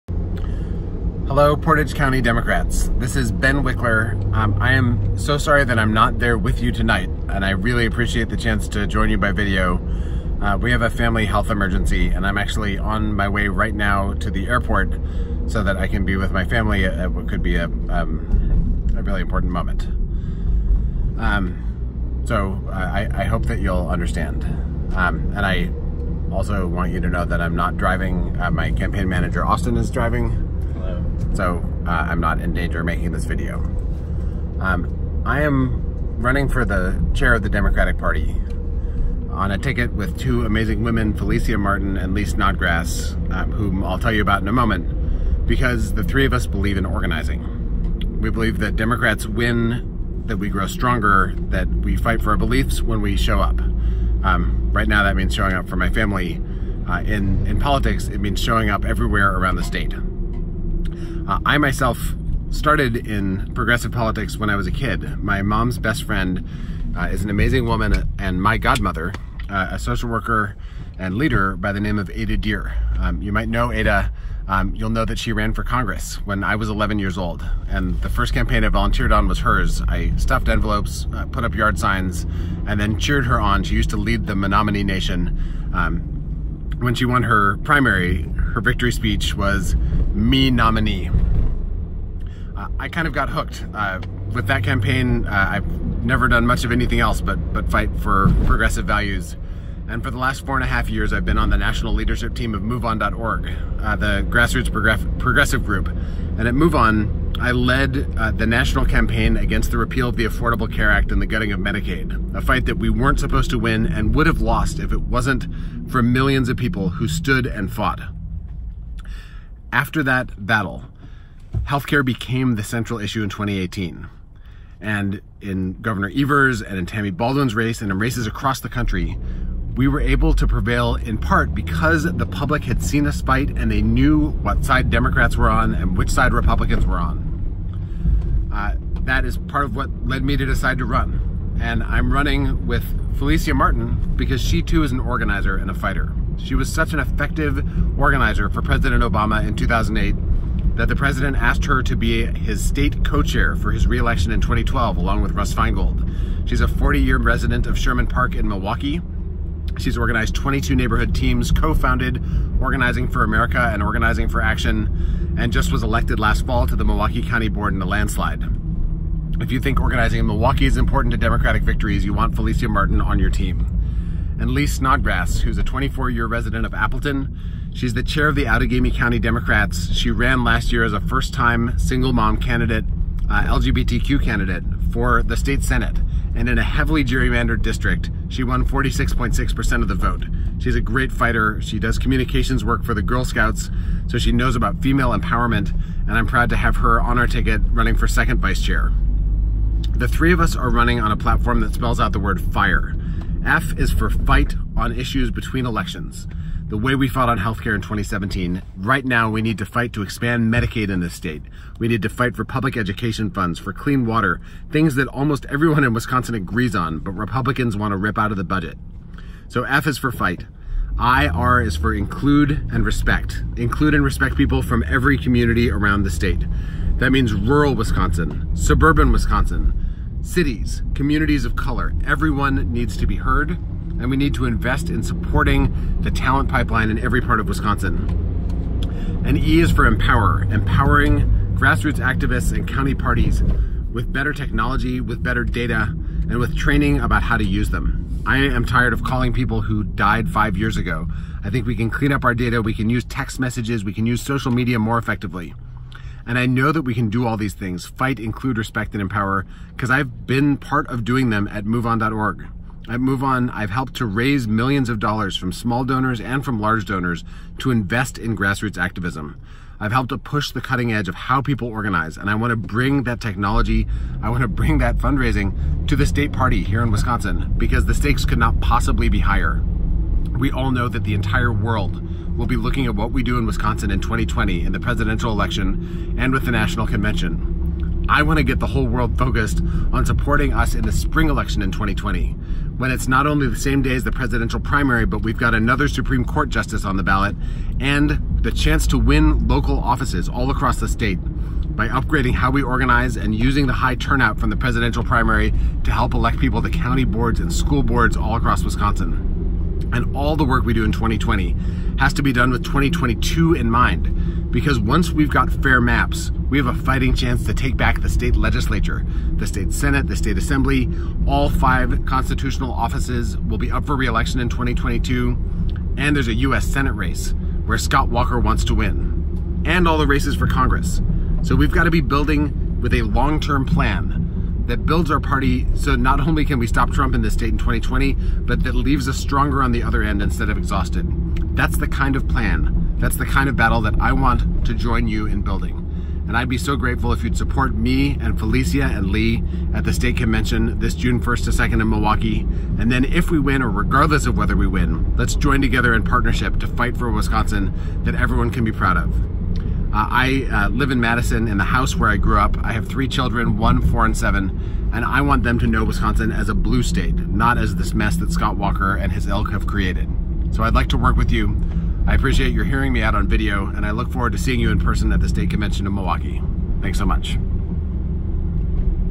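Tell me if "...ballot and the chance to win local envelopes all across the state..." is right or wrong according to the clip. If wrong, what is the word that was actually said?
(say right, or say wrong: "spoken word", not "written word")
wrong: "offices", not "envelopes".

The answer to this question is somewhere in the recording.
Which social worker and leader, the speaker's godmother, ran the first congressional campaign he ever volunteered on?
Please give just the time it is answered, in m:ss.
1:12.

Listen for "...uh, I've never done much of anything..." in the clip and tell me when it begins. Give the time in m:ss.
1:35.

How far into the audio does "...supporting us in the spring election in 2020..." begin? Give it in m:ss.
4:50.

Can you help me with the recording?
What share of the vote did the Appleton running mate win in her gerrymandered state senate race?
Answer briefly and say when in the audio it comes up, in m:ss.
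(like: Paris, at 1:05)
46.6%, at 3:08.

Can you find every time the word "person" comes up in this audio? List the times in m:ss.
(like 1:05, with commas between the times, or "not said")
6:14.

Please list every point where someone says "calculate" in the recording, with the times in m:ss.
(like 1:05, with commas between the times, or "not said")
not said.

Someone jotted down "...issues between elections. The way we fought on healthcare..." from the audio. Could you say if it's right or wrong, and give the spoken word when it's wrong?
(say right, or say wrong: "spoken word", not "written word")
right.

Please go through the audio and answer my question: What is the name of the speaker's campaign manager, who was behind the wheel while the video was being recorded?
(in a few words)
Austin.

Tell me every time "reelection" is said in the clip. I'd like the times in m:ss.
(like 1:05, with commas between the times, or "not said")
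2:33, 5:23.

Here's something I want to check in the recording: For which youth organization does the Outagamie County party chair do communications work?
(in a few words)
Girl Scouts.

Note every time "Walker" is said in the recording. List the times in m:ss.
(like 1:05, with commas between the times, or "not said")
5:28, 6:08.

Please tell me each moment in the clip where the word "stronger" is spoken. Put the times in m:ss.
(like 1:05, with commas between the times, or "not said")
0:50, 5:39.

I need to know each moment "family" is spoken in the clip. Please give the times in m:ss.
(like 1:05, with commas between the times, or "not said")
0:10, 0:16, 0:55.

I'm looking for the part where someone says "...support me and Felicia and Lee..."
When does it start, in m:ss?
5:47.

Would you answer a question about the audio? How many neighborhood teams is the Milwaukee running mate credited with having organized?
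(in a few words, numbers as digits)
22.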